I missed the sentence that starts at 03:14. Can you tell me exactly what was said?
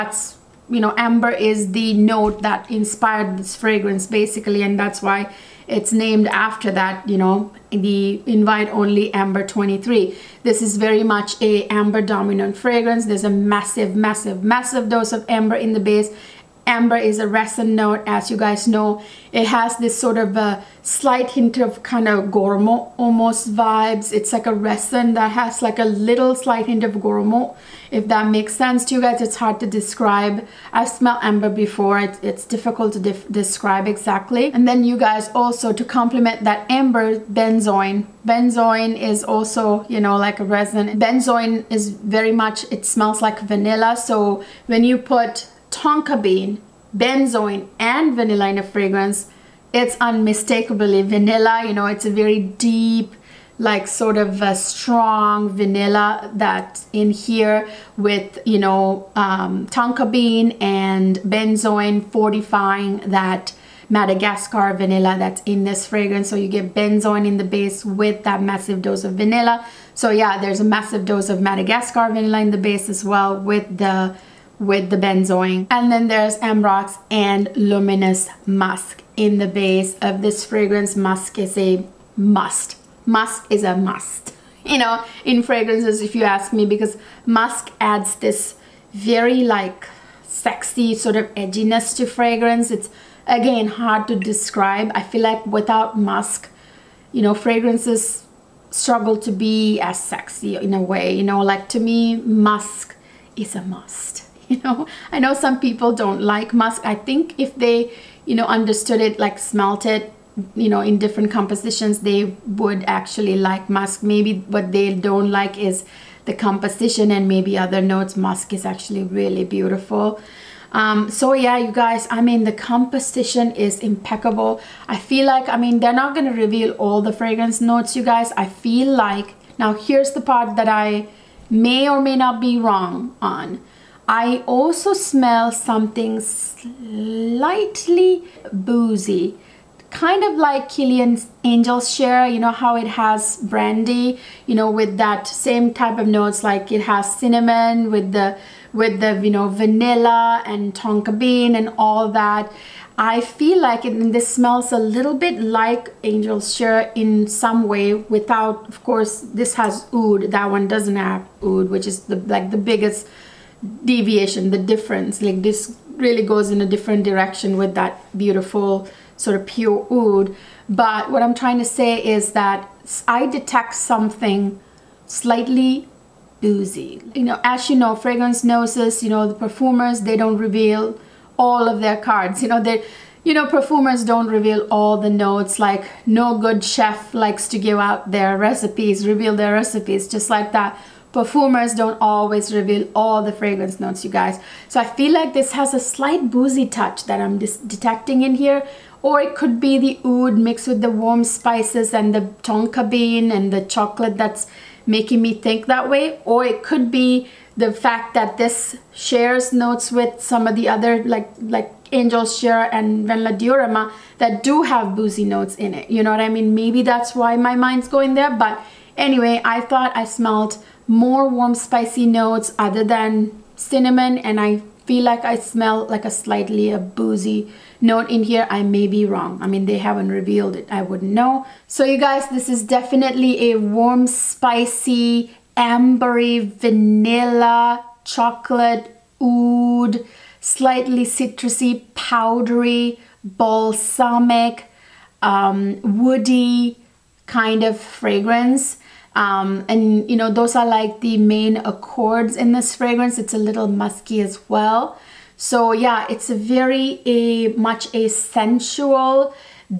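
So I feel like this has a slight boozy touch that I'm detecting in here.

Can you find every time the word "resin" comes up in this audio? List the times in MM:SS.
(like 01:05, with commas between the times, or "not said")
00:17, 00:24, 00:40.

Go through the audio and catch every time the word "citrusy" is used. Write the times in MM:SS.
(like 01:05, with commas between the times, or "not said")
04:01.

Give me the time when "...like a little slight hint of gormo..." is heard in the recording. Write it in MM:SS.
00:25.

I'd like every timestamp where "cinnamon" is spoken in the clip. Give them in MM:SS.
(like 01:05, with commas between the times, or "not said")
02:27, 03:43.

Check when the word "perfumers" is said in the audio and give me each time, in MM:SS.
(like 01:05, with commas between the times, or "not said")
02:59, 03:03, 03:11.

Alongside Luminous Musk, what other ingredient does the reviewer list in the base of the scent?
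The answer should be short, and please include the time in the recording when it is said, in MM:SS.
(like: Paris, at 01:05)
Ambrox, at 01:16.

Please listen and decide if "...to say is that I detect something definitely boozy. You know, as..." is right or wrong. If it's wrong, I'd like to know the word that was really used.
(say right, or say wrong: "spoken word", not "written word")
wrong: "slightly", not "definitely".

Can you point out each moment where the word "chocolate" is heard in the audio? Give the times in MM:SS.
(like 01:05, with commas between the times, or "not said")
03:23, 03:58.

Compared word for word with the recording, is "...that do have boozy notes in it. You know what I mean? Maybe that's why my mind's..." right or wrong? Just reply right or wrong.
right.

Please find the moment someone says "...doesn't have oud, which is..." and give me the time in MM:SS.
02:40.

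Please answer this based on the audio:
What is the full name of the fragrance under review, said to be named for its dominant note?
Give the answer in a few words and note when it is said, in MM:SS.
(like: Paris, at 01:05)
Invite Only Amber 23, at 00:08.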